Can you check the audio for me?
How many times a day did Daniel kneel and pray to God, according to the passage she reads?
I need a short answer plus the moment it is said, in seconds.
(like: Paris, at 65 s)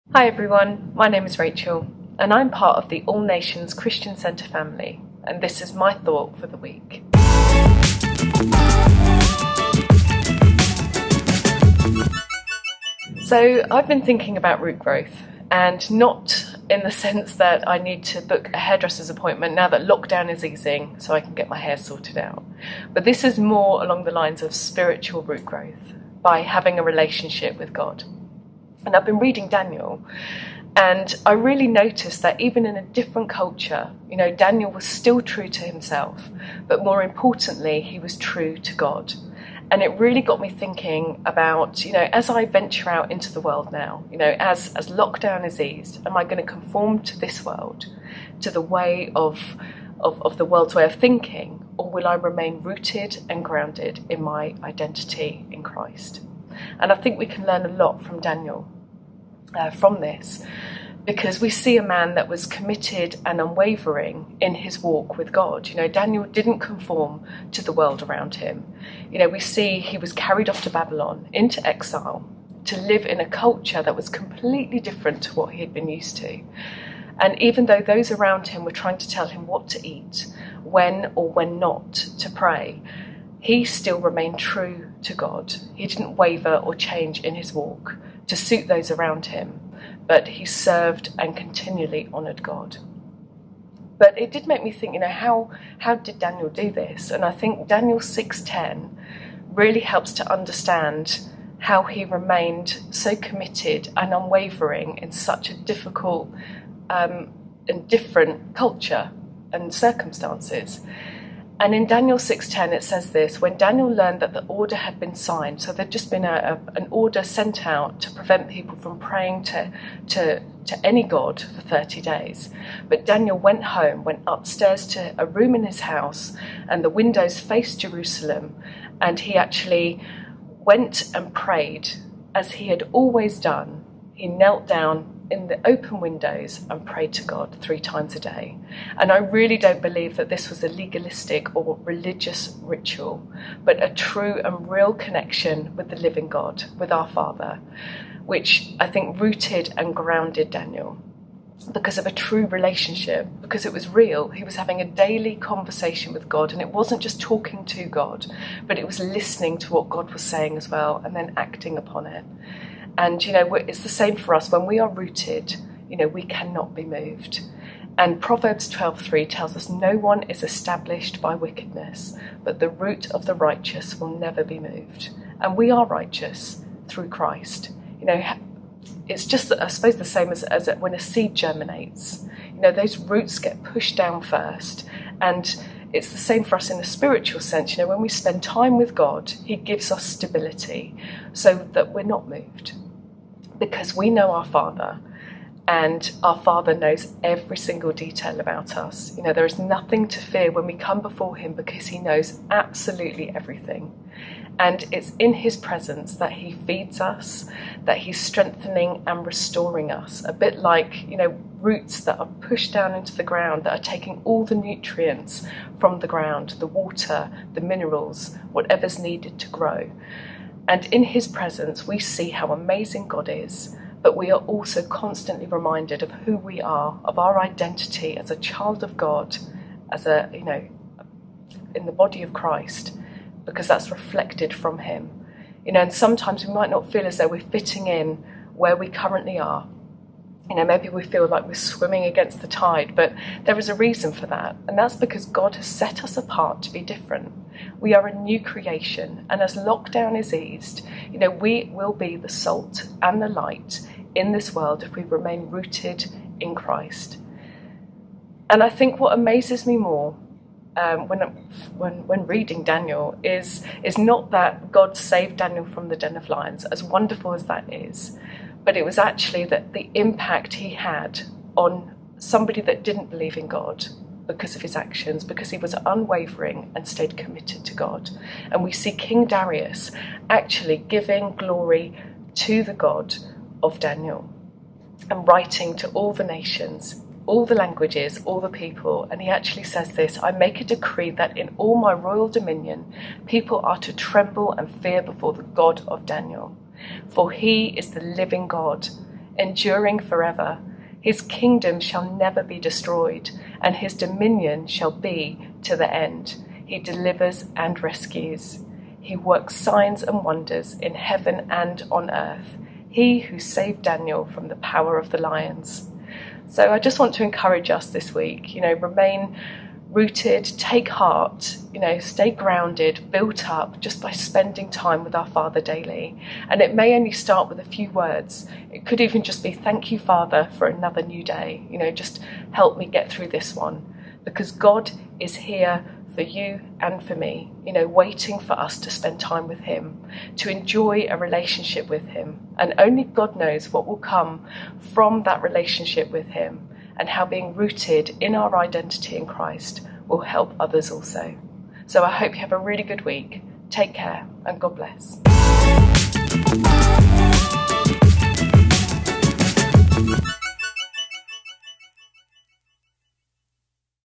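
3, at 137 s.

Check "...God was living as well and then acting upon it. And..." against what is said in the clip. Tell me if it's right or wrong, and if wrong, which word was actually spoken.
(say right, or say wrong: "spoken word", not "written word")
wrong: "saying", not "living".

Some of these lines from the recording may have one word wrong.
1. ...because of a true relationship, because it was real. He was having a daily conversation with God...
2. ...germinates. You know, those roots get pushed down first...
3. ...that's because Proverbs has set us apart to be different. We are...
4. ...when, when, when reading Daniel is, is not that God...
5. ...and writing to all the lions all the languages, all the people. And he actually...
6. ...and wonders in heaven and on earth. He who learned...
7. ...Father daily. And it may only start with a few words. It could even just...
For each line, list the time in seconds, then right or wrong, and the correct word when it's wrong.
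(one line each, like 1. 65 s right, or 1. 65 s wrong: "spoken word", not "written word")
1. 151 s right
2. 181 s right
3. 244 s wrong: "God", not "Proverbs"
4. 261 s right
5. 285 s wrong: "nations", not "lions"
6. 310 s wrong: "saved", not "learned"
7. 325 s right.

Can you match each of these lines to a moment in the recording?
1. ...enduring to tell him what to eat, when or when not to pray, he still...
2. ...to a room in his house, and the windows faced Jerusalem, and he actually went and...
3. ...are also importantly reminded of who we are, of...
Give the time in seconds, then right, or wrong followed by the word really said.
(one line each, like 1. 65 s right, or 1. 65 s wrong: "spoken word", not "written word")
1. 78 s wrong: "trying", not "enduring"
2. 124 s right
3. 224 s wrong: "constantly", not "importantly".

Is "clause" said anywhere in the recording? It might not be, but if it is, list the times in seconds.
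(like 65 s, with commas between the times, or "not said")
not said.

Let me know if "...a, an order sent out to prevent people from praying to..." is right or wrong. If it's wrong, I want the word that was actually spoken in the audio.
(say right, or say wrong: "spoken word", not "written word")
right.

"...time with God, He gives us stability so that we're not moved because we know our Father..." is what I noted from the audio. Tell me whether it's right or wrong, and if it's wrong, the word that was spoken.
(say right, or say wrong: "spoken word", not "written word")
right.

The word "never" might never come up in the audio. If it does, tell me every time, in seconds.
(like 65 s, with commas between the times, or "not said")
174 s, 302 s.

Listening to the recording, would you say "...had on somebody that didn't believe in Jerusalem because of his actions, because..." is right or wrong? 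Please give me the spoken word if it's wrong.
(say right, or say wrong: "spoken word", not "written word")
wrong: "God", not "Jerusalem".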